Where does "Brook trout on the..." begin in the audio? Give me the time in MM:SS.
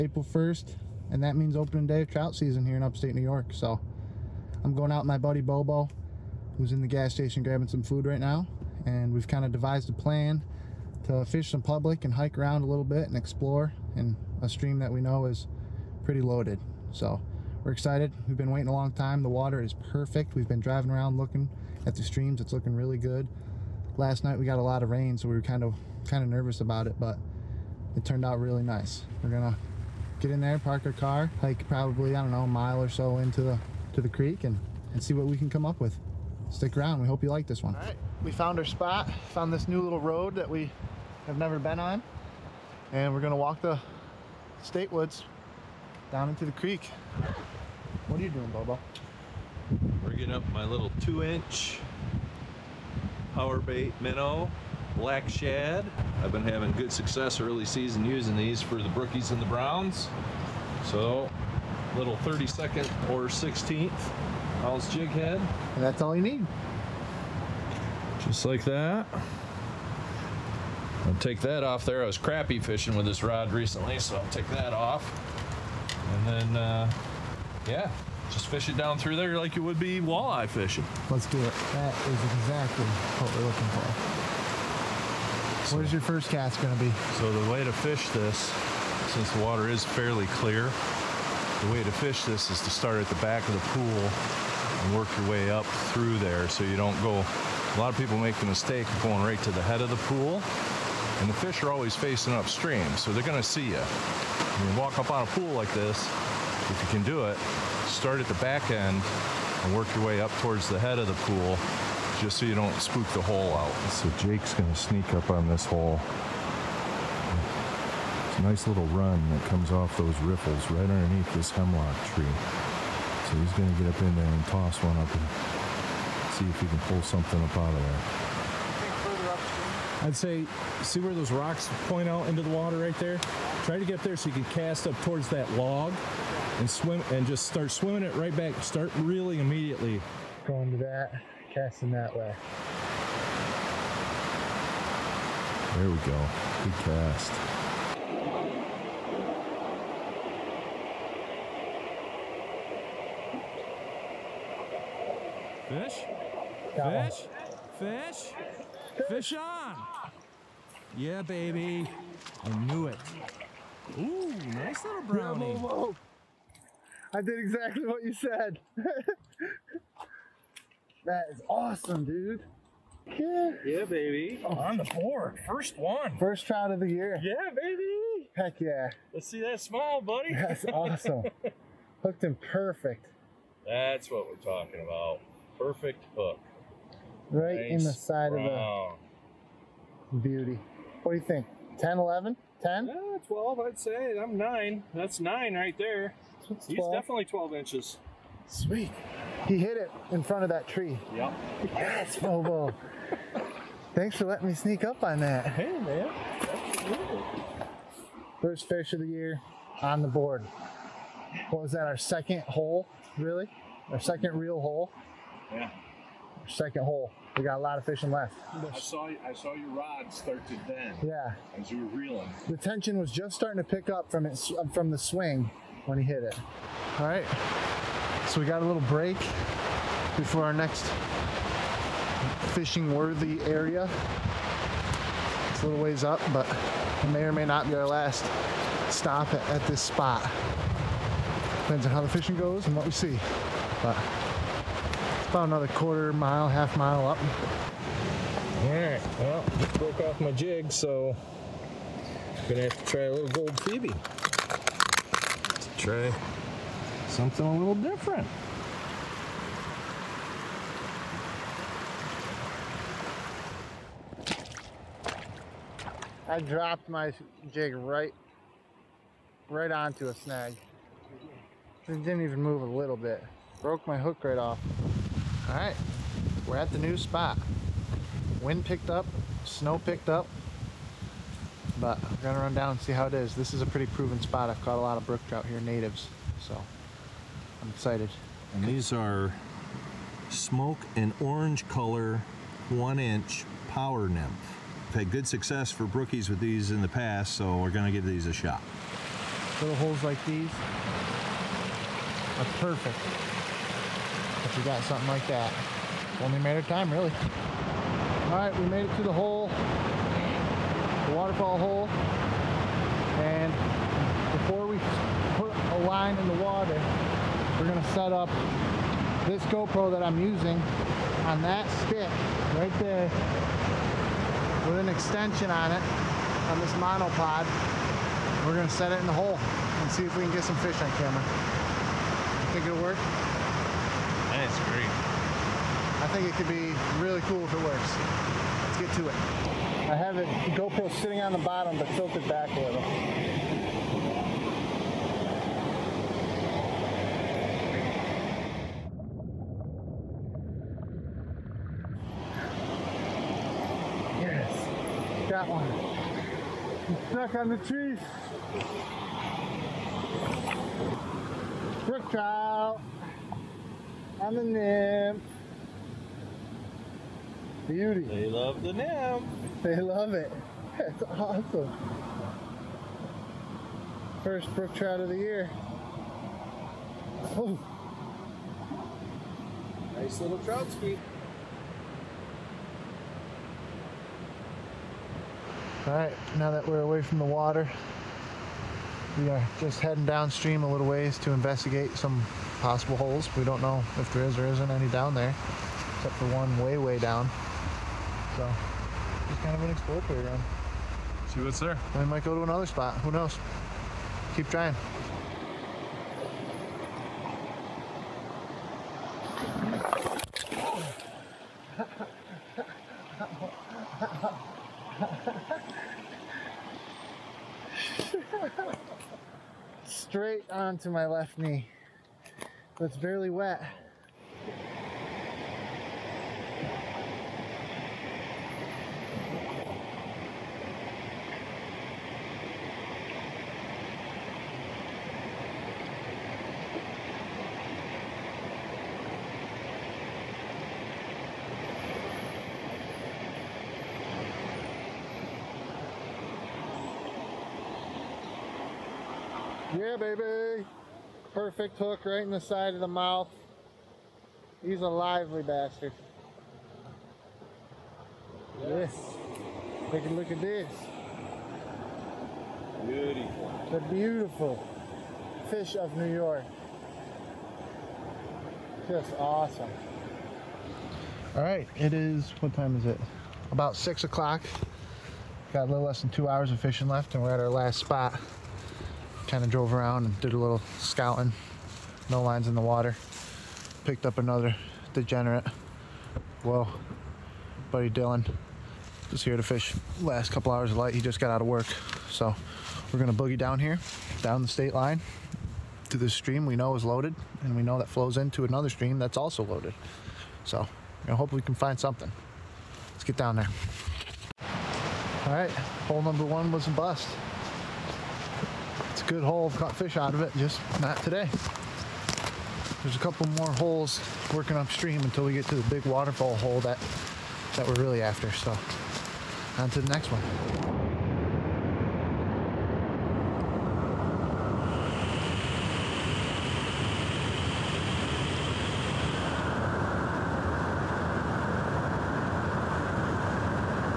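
06:01.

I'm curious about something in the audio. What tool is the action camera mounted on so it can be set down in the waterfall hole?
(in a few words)
monopod.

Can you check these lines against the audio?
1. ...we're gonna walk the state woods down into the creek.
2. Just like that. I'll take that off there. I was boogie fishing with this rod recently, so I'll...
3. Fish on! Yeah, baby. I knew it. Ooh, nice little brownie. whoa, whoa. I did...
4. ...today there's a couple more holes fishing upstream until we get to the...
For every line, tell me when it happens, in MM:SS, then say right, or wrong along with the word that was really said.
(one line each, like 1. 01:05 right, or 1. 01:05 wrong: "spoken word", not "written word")
1. 00:43 right
2. 01:08 wrong: "crappie", not "boogie"
3. 02:39 right
4. 08:31 wrong: "working", not "fishing".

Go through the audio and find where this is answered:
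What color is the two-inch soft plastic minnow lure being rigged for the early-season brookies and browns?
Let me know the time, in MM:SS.
00:54.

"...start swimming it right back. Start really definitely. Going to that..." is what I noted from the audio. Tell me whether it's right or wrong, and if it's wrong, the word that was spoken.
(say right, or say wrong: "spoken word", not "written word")
wrong: "immediately", not "definitely".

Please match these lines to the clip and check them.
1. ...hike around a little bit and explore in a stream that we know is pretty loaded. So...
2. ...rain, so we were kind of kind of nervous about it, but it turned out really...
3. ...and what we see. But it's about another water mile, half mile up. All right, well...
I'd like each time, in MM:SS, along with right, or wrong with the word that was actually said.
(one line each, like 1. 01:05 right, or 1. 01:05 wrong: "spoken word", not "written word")
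1. 00:12 right
2. 00:24 right
3. 04:02 wrong: "quarter", not "water".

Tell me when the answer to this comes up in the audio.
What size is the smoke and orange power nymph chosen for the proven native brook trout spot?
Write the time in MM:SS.
04:52.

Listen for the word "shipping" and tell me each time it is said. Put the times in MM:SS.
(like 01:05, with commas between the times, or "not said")
not said.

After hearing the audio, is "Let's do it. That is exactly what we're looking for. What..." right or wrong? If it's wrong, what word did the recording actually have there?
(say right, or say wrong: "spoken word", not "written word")
right.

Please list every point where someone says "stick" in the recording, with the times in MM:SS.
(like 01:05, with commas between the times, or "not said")
00:36, 05:21.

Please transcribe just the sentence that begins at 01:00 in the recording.
So little 32nd or 16th all's jig head.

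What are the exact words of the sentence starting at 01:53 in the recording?
So Jake's going to sneak up on this hole.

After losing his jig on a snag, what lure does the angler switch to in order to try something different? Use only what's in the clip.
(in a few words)
gold Phoebe.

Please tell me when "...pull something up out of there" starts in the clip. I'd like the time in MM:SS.
02:06.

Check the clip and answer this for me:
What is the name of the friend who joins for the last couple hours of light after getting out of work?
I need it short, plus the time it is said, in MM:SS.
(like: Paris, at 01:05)
Dylan, at 08:07.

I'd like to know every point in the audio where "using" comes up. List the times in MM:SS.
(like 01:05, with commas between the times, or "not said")
00:58, 05:20.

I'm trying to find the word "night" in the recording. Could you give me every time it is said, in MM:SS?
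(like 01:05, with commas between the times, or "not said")
00:24.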